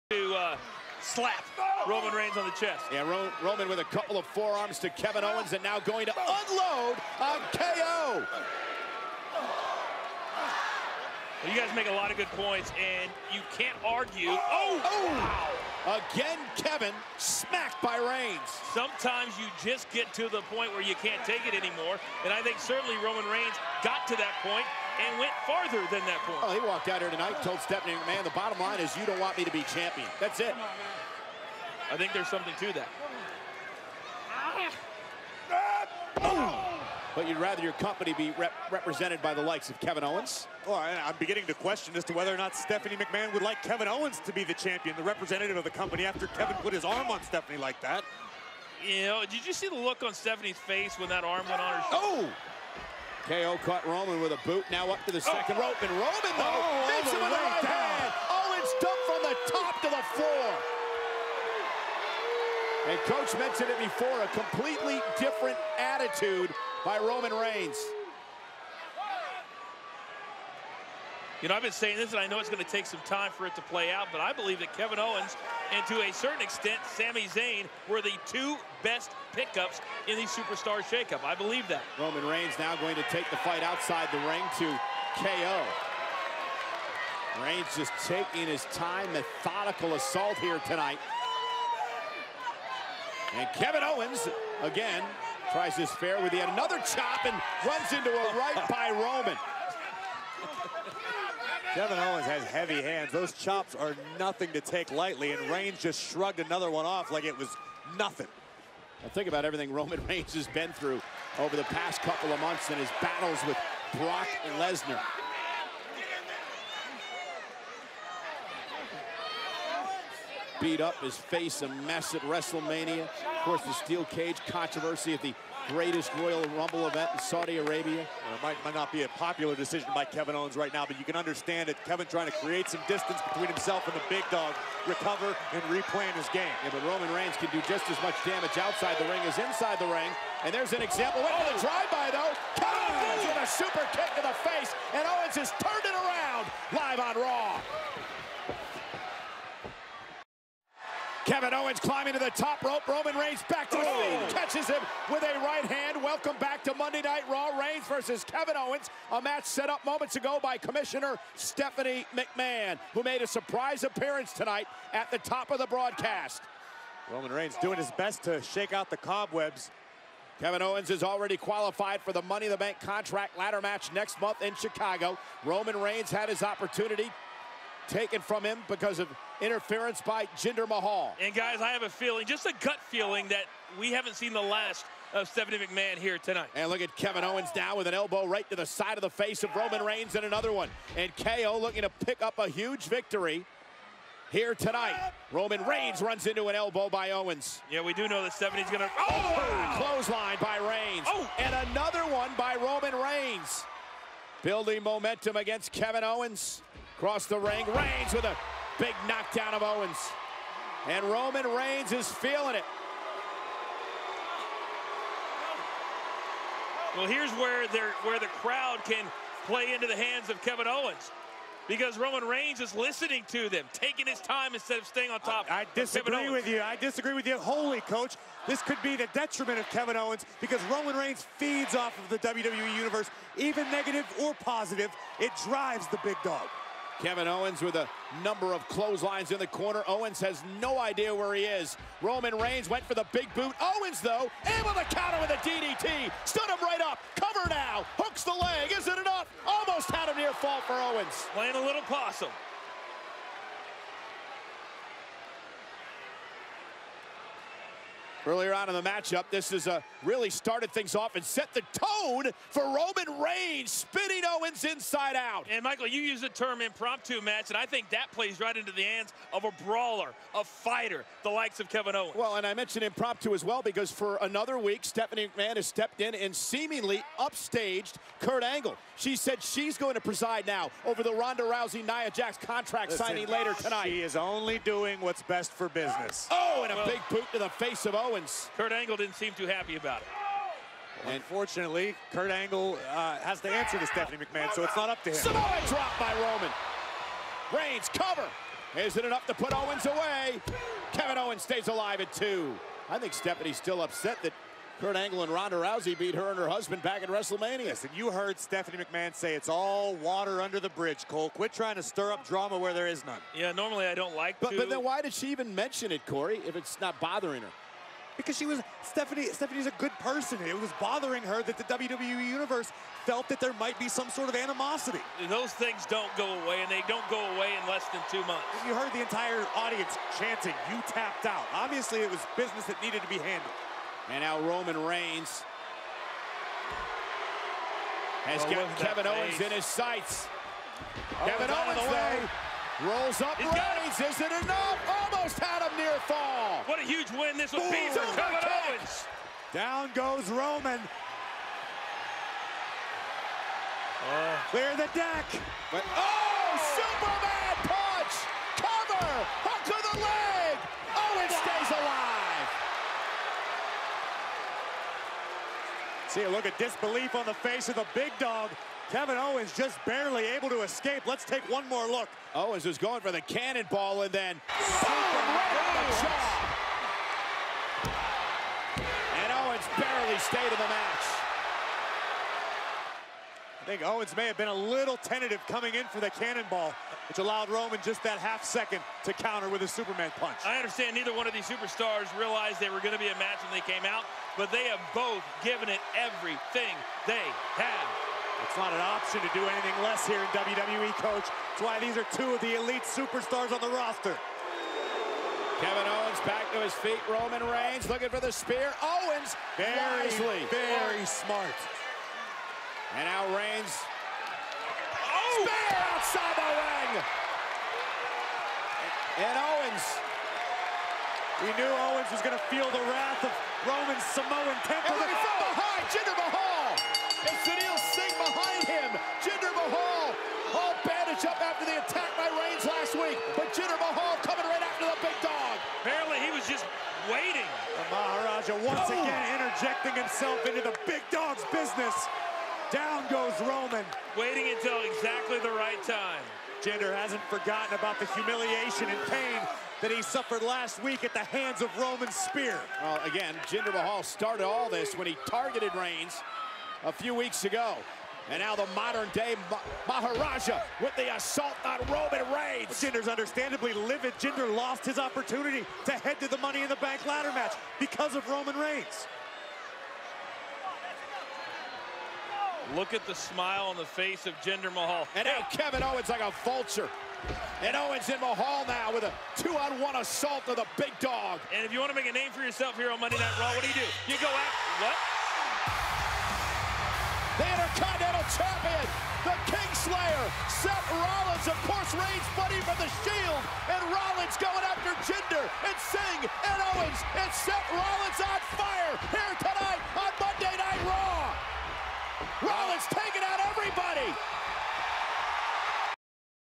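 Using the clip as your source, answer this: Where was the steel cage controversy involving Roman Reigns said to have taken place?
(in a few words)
Saudi Arabia.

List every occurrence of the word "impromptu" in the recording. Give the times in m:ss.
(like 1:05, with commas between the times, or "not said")
4:26, 4:32.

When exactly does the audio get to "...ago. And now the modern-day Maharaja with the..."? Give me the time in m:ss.
7:37.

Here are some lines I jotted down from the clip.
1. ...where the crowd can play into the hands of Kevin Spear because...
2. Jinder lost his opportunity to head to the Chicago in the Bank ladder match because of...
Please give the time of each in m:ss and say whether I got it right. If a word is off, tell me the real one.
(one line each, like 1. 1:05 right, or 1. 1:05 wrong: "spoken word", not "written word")
1. 3:38 wrong: "Owens", not "Spear"
2. 7:44 wrong: "Money", not "Chicago".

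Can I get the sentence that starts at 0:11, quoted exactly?
You guys make a lot of good points, and you can't argue.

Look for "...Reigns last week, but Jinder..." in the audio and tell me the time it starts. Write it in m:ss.
7:12.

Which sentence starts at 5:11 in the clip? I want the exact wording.
Quit trying to stir up drama where there is none.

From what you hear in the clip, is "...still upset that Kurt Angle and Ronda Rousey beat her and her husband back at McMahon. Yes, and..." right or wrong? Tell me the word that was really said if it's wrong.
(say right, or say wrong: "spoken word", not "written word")
wrong: "WrestleMania", not "McMahon".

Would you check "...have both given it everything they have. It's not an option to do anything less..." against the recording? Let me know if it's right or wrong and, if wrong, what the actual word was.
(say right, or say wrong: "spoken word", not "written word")
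right.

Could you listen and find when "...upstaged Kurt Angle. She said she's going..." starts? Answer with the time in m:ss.
4:37.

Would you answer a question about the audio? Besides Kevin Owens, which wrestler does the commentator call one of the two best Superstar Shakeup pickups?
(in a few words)
Sami Zayn.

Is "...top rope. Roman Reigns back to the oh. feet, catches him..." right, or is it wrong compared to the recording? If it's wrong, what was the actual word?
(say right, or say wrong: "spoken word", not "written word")
right.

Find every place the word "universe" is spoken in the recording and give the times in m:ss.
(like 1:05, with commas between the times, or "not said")
3:52, 5:22.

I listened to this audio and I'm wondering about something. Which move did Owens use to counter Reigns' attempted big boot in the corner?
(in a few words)
DDT.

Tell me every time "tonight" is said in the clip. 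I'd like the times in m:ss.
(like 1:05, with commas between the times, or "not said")
0:27, 1:30, 2:44, 3:06, 3:14, 4:43, 8:19.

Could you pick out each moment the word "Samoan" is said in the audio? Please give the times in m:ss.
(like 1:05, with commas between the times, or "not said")
4:55, 7:04.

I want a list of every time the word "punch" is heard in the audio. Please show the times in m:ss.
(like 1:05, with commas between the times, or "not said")
5:57, 6:30.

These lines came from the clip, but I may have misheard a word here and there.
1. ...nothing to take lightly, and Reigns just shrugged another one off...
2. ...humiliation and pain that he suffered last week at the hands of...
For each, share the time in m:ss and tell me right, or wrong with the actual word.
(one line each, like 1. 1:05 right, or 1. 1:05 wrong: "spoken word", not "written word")
1. 1:44 right
2. 7:28 right.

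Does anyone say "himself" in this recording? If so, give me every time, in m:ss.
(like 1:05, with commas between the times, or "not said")
2:13, 7:19.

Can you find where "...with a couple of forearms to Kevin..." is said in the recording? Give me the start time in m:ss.
0:03.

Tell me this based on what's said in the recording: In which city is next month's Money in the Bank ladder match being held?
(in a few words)
Chicago.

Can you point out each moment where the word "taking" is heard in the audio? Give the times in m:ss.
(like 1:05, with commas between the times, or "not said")
1:28, 3:43, 8:22.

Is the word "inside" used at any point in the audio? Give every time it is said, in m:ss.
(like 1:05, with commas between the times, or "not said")
2:19, 4:24.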